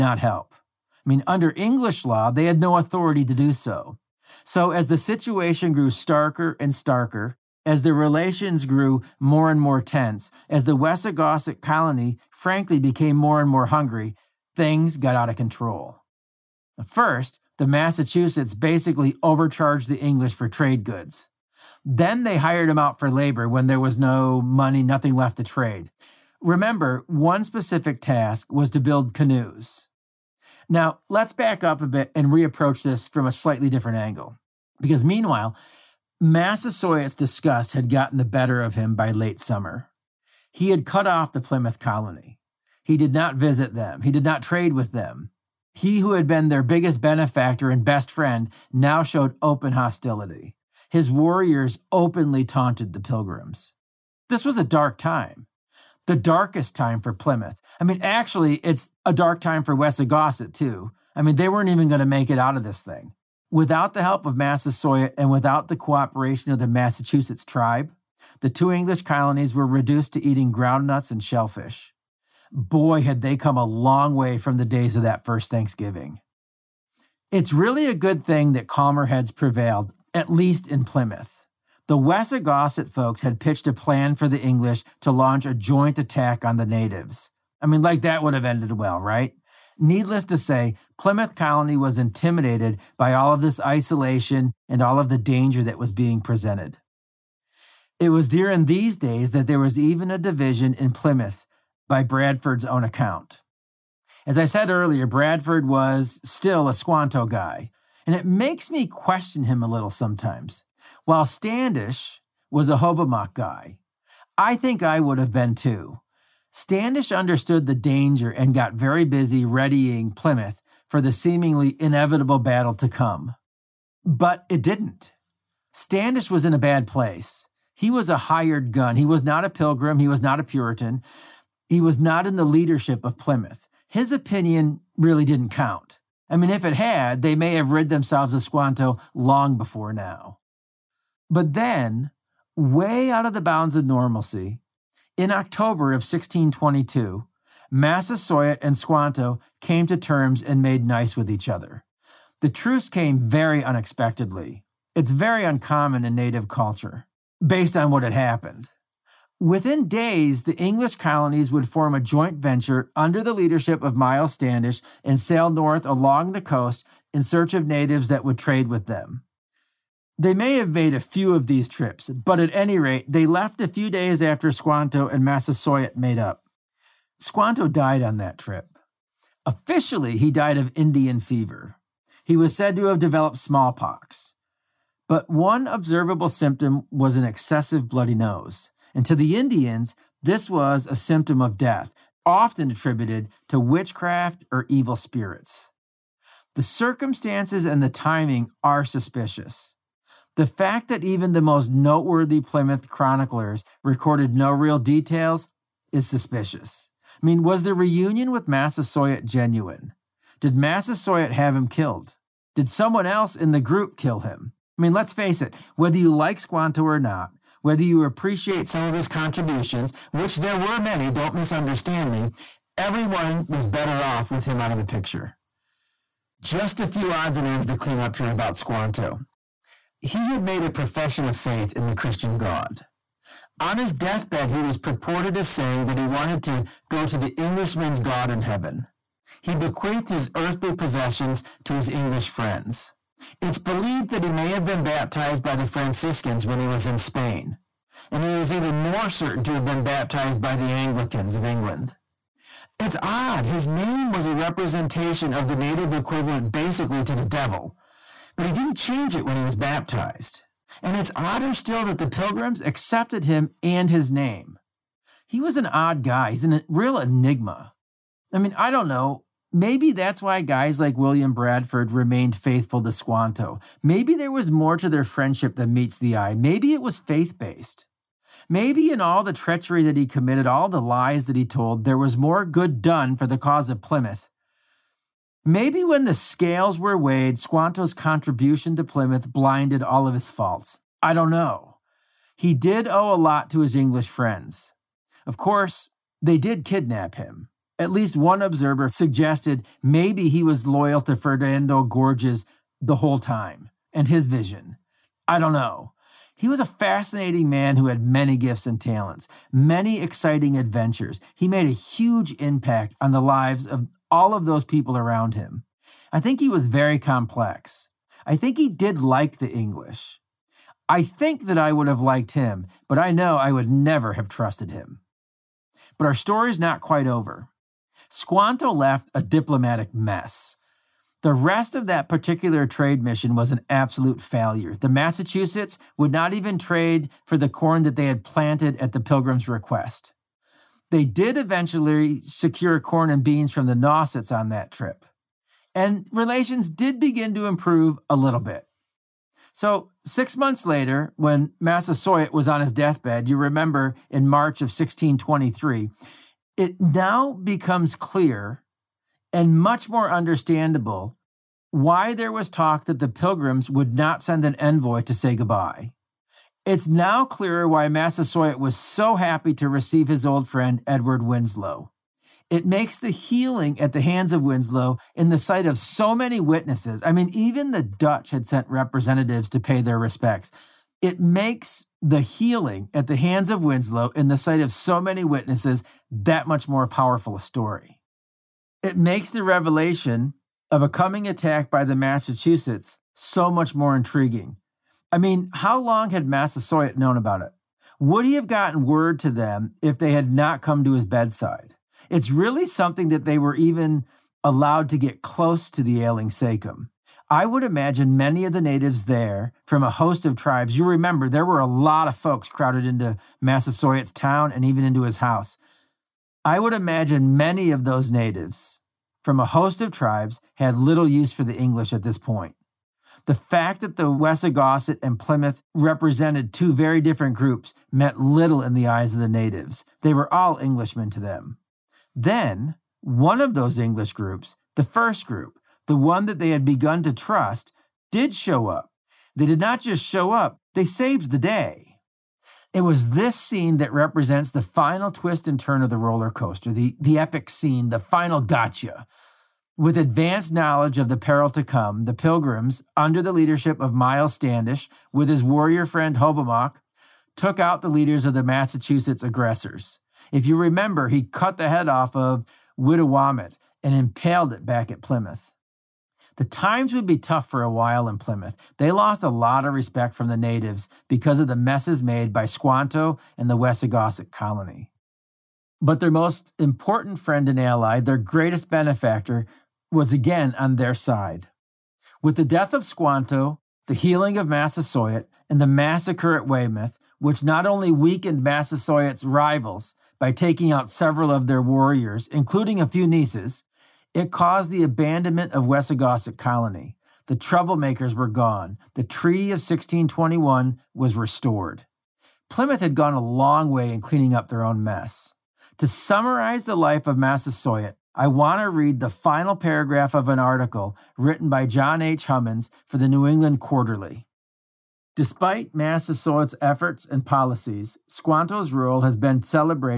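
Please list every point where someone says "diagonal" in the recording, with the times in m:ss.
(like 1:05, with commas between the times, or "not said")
not said.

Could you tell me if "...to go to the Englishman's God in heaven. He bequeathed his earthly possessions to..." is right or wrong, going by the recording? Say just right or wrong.
right.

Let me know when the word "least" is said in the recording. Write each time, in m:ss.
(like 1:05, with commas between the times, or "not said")
1:20, 4:57.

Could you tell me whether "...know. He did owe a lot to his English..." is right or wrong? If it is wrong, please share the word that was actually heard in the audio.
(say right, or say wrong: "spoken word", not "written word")
right.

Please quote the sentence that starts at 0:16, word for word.
First, the Massachusetts basically overcharged the English for trade goods.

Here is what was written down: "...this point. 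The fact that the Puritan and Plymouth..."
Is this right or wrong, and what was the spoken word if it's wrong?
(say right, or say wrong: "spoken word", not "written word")
wrong: "Wessagusset", not "Puritan".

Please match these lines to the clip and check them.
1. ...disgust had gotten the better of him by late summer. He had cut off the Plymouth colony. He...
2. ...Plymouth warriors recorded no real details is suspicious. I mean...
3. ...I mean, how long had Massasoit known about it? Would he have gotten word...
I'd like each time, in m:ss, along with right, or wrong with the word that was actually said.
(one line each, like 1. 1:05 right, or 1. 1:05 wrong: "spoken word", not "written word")
1. 0:37 right
2. 3:22 wrong: "chroniclers", not "warriors"
3. 6:35 right.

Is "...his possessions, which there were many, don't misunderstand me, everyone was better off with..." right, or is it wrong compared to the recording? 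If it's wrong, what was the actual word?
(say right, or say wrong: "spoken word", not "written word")
wrong: "contributions", not "possessions".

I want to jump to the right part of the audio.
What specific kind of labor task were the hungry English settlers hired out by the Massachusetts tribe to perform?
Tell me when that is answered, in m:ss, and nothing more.
0:28.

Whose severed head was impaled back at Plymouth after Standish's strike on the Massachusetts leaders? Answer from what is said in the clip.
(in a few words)
Wittawamat.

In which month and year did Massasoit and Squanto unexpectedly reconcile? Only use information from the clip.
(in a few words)
October 1622.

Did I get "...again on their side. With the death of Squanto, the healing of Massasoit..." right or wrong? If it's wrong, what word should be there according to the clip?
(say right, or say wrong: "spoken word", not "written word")
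right.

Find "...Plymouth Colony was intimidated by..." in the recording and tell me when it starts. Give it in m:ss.
1:30.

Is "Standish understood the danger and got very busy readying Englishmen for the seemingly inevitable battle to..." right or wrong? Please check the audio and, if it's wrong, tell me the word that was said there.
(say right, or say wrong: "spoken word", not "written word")
wrong: "Plymouth", not "Englishmen".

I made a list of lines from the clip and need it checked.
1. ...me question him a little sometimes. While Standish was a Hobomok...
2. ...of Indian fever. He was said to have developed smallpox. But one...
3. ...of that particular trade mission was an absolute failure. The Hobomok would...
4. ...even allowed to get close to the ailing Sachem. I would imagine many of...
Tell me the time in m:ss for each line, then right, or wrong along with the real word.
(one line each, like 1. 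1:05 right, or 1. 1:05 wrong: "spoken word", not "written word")
1. 1:48 right
2. 3:00 right
3. 5:31 wrong: "Massachusetts", not "Hobomok"
4. 6:43 right.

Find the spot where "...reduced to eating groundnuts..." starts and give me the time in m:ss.
1:09.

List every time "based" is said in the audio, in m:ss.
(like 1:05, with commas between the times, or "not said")
2:37, 4:37.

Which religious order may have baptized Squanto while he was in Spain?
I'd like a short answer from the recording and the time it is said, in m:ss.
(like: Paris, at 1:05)
The Franciscans, at 4:05.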